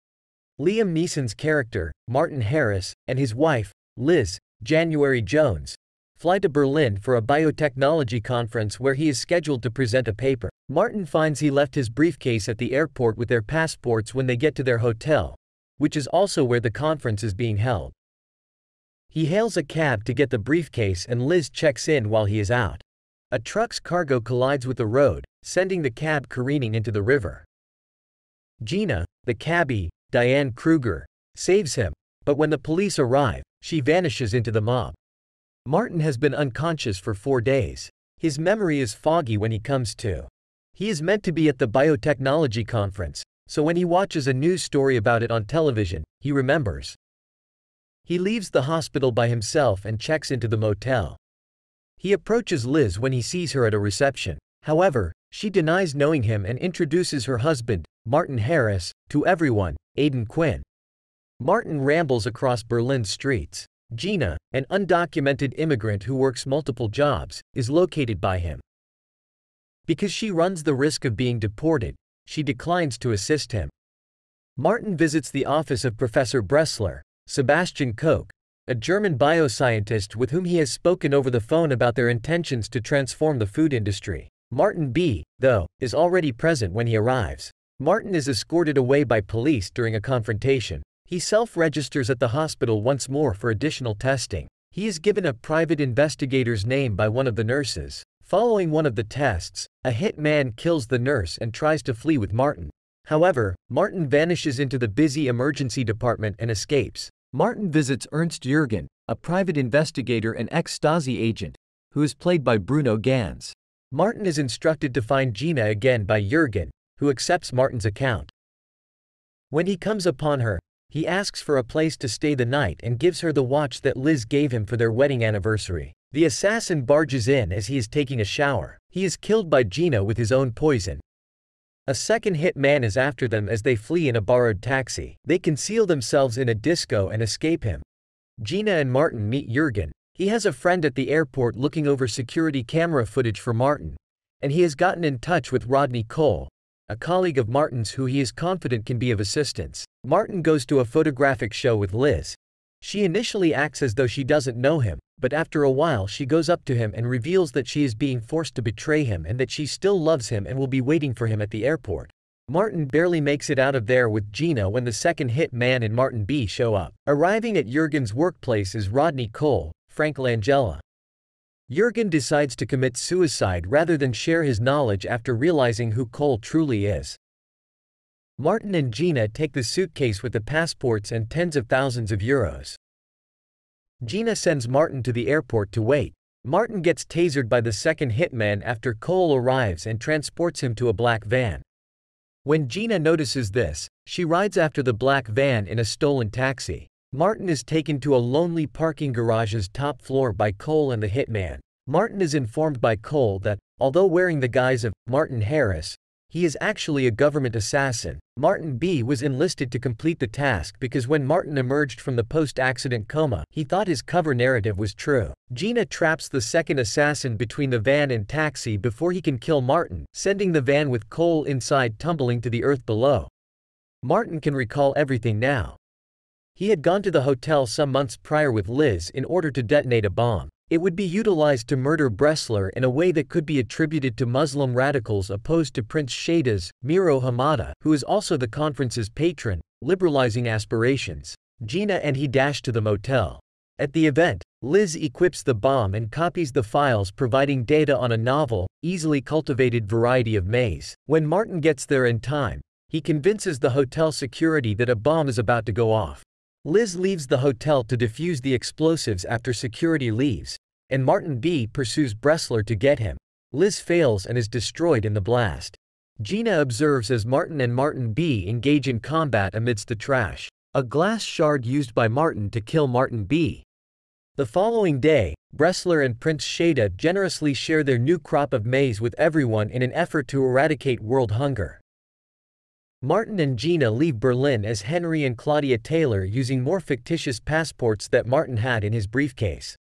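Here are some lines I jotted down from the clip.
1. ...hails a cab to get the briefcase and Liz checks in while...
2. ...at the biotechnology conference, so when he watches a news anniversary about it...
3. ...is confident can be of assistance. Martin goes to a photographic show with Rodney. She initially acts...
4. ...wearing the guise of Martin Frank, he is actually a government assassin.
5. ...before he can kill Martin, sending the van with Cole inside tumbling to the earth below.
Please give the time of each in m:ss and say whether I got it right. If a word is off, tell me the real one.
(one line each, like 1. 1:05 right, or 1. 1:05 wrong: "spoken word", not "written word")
1. 0:19 right
2. 0:41 wrong: "story", not "anniversary"
3. 2:28 wrong: "Liz", not "Rodney"
4. 3:24 wrong: "Harris", not "Frank"
5. 3:38 right.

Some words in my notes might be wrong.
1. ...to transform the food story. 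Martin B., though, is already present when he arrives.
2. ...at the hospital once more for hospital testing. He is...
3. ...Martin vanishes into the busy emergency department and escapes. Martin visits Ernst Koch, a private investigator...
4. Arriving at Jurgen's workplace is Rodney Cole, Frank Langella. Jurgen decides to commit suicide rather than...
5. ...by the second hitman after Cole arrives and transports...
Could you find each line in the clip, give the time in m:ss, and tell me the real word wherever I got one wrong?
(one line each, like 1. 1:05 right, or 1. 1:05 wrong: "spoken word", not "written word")
1. 1:22 wrong: "industry", not "story"
2. 1:32 wrong: "additional", not "hospital"
3. 1:43 wrong: "Jürgen", not "Koch"
4. 2:47 right
5. 3:07 right.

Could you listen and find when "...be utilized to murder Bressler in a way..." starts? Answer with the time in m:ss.
3:50.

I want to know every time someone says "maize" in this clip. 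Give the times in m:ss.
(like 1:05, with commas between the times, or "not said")
4:10, 4:38.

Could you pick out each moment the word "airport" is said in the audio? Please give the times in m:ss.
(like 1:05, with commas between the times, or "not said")
0:12, 2:21, 2:41, 3:05.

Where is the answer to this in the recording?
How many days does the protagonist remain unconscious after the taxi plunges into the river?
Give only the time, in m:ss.
0:37.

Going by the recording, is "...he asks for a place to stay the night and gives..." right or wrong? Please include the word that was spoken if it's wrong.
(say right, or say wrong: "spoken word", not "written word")
right.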